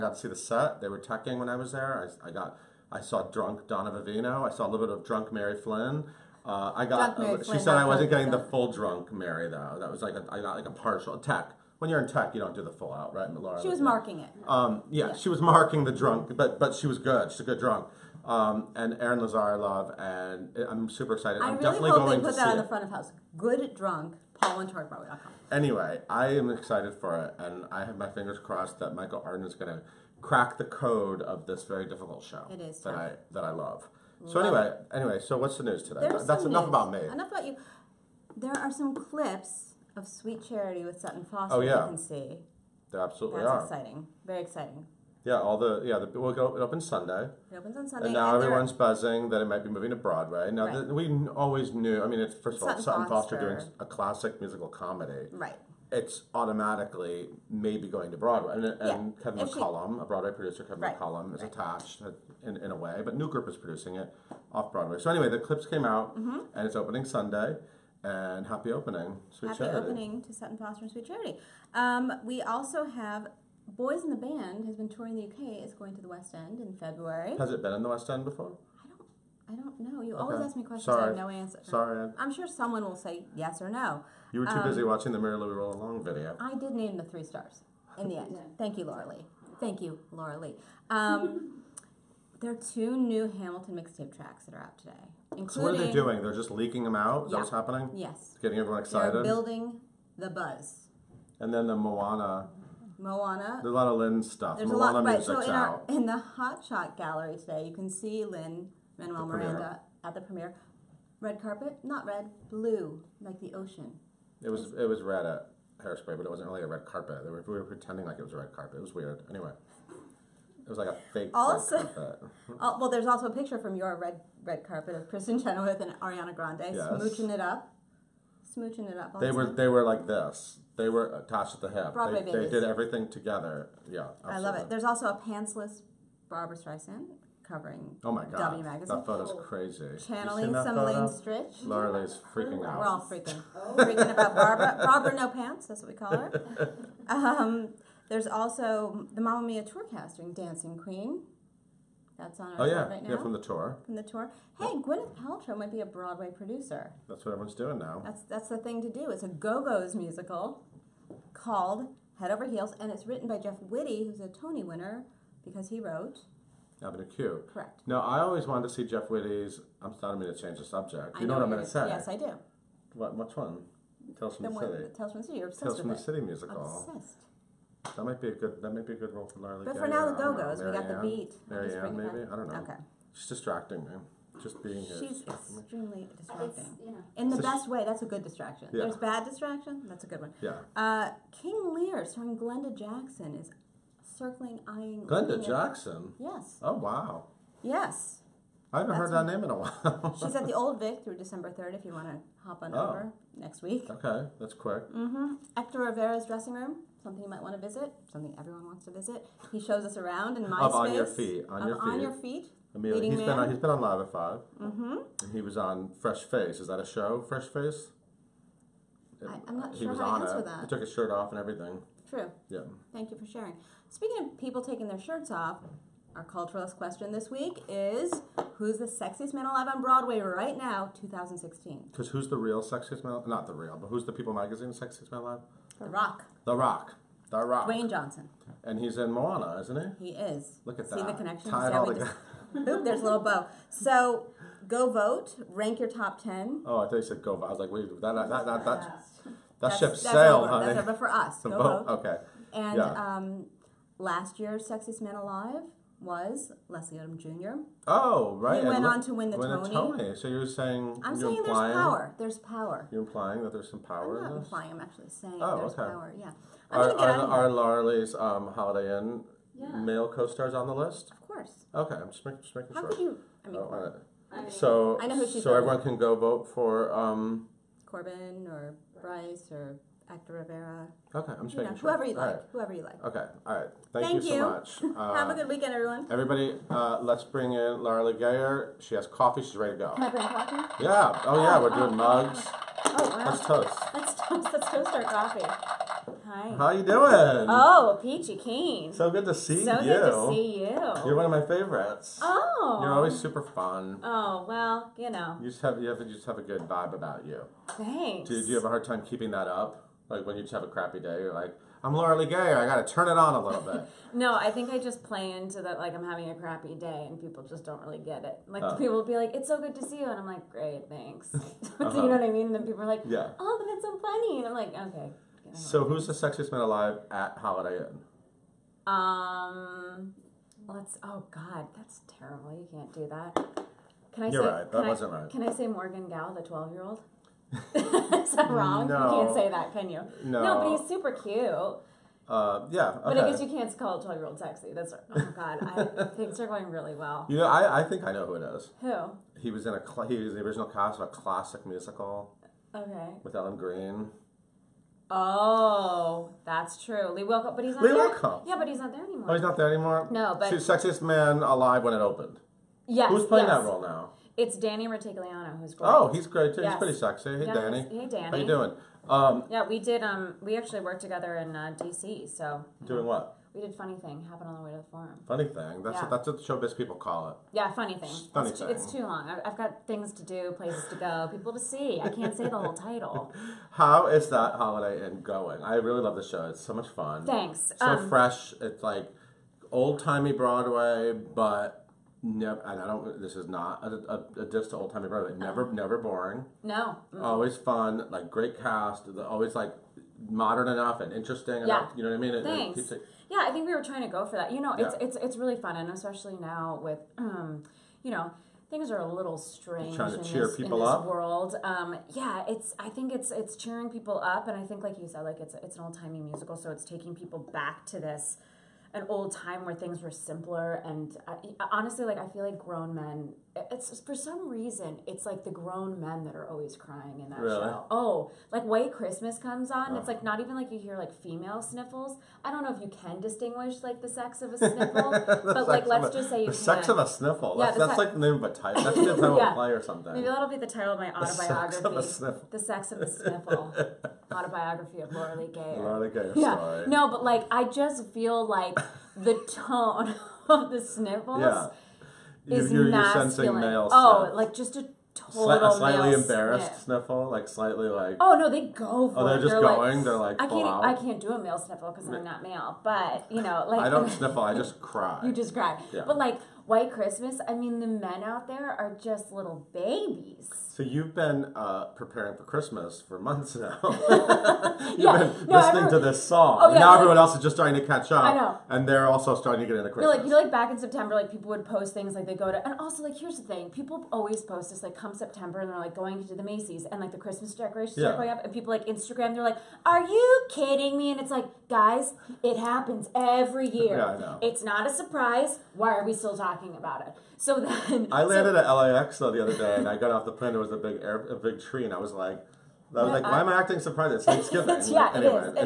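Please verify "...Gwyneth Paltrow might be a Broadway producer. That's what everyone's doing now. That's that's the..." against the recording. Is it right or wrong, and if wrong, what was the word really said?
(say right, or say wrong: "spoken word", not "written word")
right.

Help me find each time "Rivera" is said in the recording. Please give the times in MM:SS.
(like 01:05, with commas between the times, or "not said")
03:25, 04:40.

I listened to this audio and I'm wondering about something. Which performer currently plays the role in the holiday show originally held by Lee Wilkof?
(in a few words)
Danny Rutigliano.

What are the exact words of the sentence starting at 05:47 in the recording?
You know, I, I think I know who it is.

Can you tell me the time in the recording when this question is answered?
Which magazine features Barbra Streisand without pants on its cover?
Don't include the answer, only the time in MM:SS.
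02:18.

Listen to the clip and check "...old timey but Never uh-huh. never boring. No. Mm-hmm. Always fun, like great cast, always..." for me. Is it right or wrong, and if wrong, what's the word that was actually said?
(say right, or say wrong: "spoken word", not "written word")
right.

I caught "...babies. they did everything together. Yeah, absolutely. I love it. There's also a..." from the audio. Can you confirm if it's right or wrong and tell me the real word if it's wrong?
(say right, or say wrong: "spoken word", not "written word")
right.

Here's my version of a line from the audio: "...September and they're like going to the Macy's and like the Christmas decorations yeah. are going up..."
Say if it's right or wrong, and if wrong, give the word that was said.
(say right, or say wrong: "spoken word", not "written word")
right.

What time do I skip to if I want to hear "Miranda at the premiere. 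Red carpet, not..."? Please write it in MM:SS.
01:49.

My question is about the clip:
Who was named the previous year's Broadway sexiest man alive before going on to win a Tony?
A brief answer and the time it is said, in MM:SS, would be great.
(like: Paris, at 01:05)
Leslie Odom Jr., at 04:16.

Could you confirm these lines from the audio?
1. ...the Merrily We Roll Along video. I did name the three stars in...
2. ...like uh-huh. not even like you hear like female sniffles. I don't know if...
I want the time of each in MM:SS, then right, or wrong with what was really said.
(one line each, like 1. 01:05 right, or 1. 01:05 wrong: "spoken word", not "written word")
1. 01:25 right
2. 07:10 right.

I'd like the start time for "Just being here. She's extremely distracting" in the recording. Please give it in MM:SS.
03:04.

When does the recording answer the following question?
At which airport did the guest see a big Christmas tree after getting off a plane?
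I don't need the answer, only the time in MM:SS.
08:18.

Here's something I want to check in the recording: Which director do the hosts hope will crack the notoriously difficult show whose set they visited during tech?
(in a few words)
Michael Arden.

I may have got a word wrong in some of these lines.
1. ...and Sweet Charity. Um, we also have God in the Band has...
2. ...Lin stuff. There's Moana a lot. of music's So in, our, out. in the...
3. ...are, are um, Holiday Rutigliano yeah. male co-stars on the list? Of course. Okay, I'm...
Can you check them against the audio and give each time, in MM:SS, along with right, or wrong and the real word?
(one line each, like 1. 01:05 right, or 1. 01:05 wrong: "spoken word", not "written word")
1. 01:10 wrong: "Boys", not "God"
2. 01:43 right
3. 04:26 wrong: "Inn", not "Rutigliano".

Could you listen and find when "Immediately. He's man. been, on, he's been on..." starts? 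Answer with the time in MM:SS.
03:32.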